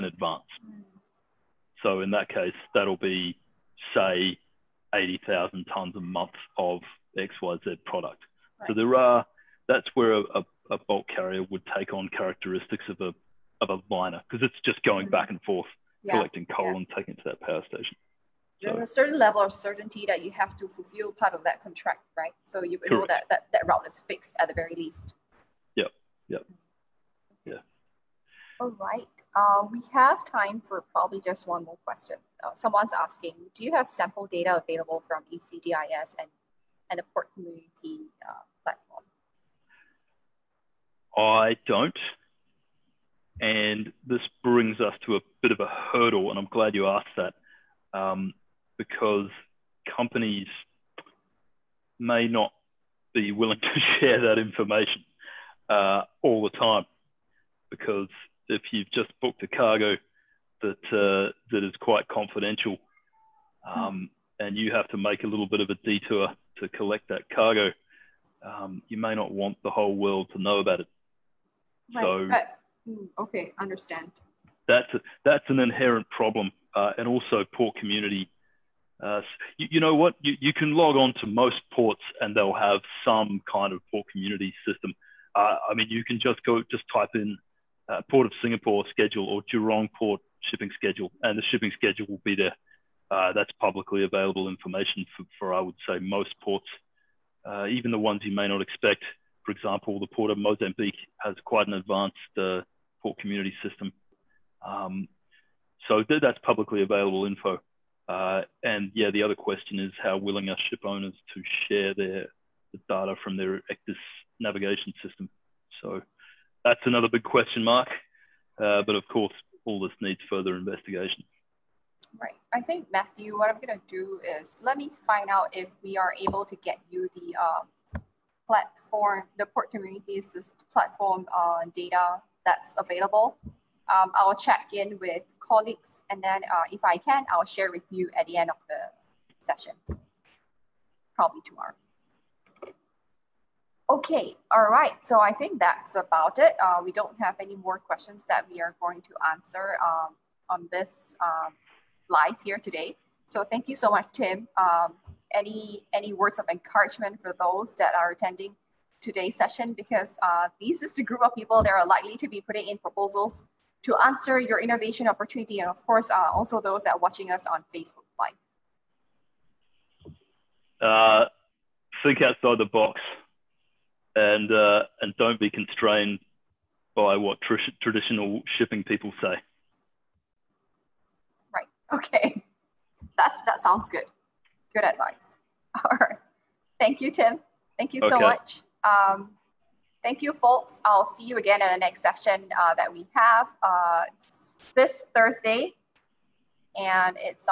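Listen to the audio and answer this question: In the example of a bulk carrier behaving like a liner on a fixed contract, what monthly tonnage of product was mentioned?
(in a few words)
80,000 tons.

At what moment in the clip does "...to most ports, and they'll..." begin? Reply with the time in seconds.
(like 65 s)
81 s.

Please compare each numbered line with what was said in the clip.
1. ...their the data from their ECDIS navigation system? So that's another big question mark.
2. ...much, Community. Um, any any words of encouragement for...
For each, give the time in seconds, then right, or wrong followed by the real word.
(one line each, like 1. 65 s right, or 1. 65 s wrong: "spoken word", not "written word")
1. 111 s right
2. 153 s wrong: "Tim", not "Community".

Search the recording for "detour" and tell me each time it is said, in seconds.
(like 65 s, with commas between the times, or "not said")
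65 s.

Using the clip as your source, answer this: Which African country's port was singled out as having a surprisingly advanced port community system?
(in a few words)
Mozambique.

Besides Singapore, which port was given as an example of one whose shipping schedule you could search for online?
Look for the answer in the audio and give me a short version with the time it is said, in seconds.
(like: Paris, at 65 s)
Jurong Port, at 89 s.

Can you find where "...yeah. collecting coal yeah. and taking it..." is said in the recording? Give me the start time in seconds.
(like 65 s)
16 s.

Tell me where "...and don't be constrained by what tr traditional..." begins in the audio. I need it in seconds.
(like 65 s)
175 s.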